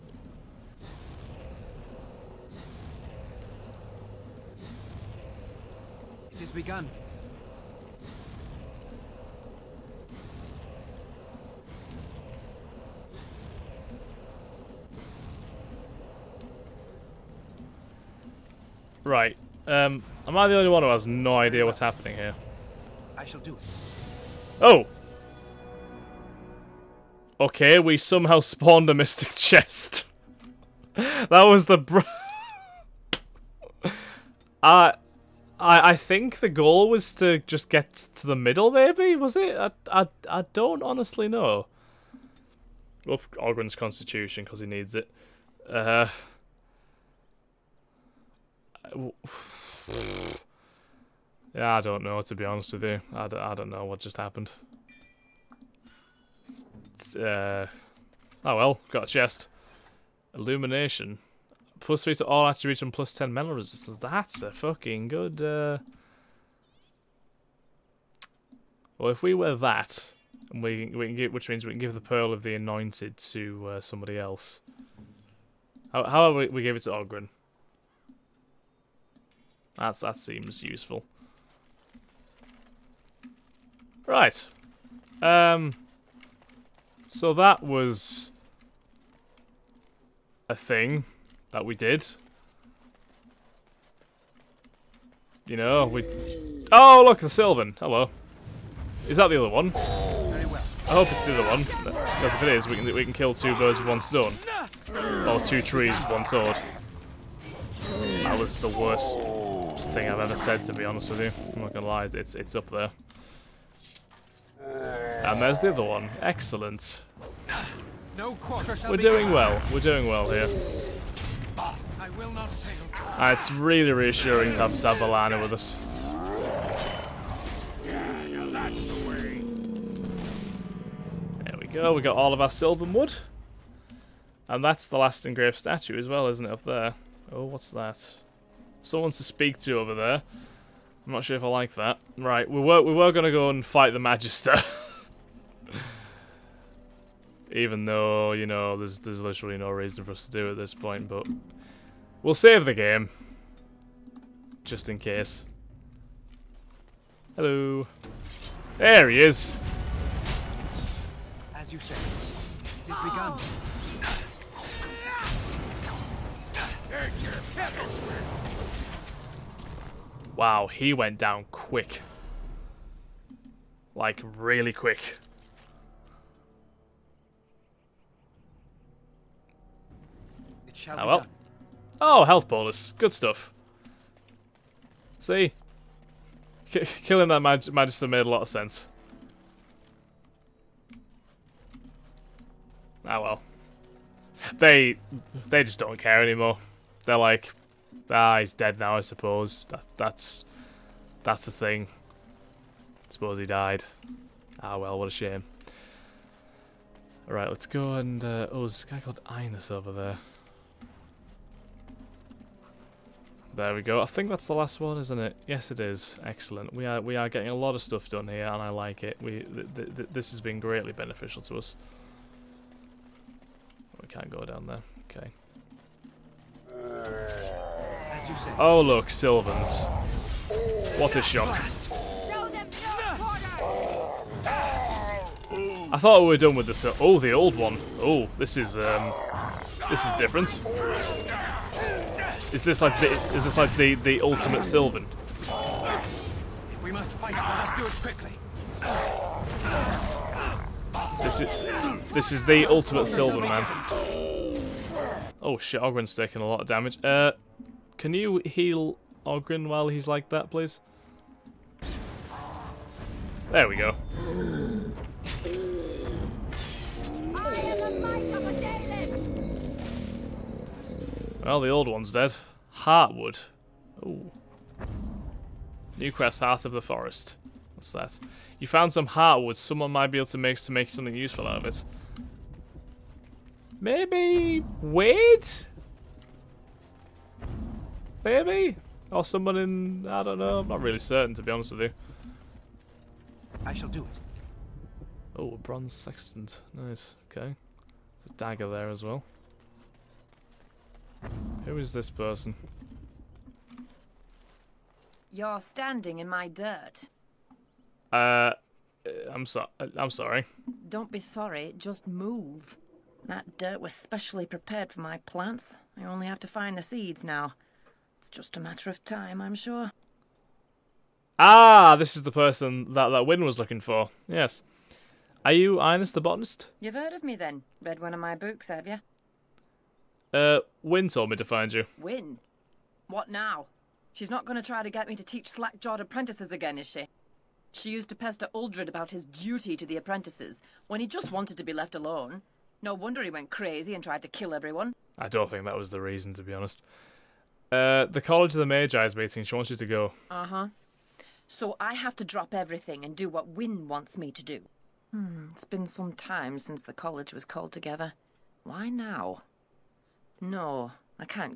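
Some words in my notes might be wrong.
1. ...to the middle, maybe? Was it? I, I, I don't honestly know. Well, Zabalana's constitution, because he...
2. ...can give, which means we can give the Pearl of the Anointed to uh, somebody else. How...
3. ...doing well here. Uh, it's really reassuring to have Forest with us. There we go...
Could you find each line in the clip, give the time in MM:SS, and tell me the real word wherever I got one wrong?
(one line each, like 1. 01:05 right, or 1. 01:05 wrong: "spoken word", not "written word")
1. 00:38 wrong: "Oghren", not "Zabalana"
2. 01:11 right
3. 01:59 wrong: "Zabalana", not "Forest".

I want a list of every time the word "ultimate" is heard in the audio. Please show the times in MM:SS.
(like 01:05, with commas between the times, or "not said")
04:04, 04:12.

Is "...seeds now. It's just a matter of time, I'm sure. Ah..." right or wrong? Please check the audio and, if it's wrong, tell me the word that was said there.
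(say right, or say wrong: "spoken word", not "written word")
right.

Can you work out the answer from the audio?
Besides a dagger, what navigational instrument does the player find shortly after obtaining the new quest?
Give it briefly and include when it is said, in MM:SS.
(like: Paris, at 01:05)
bronze sextant, at 04:55.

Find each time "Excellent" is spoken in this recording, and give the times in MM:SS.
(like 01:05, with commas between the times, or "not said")
01:56, 03:36.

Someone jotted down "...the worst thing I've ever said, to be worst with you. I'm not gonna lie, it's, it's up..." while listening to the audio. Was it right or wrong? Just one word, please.
wrong.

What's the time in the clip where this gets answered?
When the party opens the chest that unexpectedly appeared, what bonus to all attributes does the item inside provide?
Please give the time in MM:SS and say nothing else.
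01:01.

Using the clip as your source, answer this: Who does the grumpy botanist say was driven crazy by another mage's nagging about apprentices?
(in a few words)
Uldred.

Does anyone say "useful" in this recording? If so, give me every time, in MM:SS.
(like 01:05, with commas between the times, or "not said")
01:20, 04:41.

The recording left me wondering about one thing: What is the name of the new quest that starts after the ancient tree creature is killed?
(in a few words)
Heart of the Forest.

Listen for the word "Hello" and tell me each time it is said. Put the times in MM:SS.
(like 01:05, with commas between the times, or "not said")
01:37, 02:37.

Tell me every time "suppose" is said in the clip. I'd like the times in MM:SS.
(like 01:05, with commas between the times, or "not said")
03:19, 03:23.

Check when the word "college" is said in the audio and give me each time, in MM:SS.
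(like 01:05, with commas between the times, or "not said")
05:48, 05:56.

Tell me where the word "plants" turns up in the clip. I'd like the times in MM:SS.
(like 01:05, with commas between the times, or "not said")
05:15.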